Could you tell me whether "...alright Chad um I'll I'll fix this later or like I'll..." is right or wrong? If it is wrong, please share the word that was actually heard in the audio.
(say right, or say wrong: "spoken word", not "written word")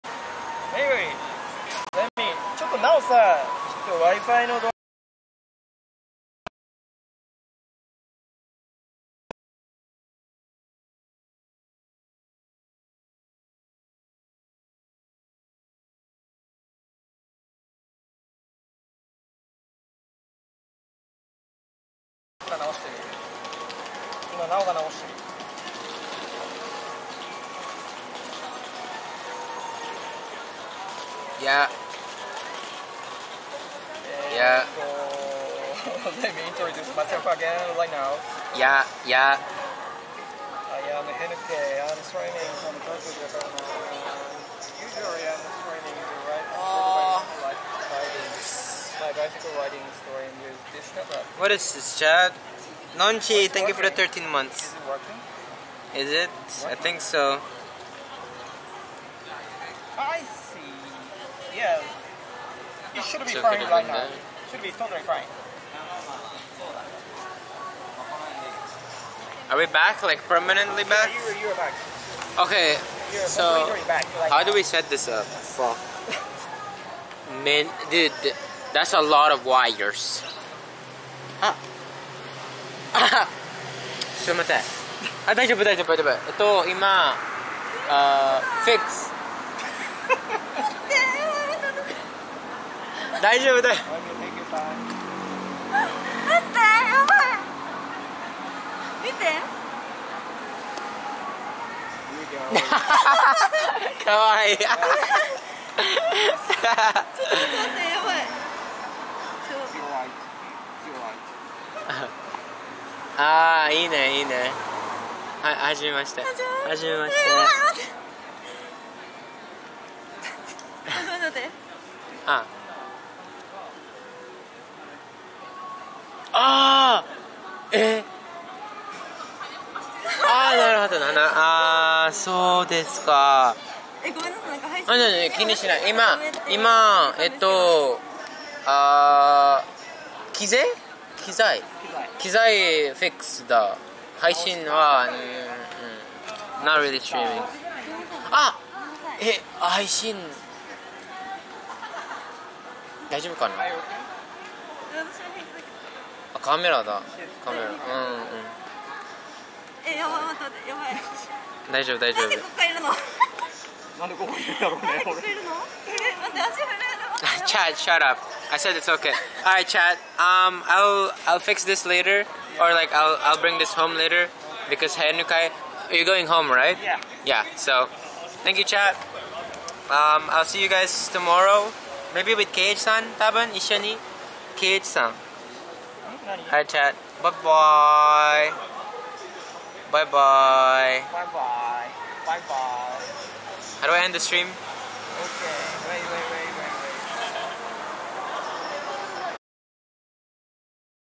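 right.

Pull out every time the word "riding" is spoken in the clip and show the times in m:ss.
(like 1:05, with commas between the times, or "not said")
0:49.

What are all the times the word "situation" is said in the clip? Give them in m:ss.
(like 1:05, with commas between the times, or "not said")
not said.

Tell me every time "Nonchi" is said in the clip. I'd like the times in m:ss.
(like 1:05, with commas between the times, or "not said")
0:52.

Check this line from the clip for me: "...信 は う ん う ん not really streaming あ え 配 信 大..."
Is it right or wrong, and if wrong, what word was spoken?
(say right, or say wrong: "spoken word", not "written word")
right.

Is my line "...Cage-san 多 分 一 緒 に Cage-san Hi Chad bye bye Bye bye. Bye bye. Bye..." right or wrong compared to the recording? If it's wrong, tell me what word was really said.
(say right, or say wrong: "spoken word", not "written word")
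right.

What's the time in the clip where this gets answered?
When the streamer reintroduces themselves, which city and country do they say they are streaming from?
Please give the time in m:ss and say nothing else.
0:42.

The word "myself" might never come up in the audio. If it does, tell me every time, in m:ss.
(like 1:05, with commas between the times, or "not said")
0:36.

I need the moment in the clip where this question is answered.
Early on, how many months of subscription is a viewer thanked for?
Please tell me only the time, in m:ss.
0:53.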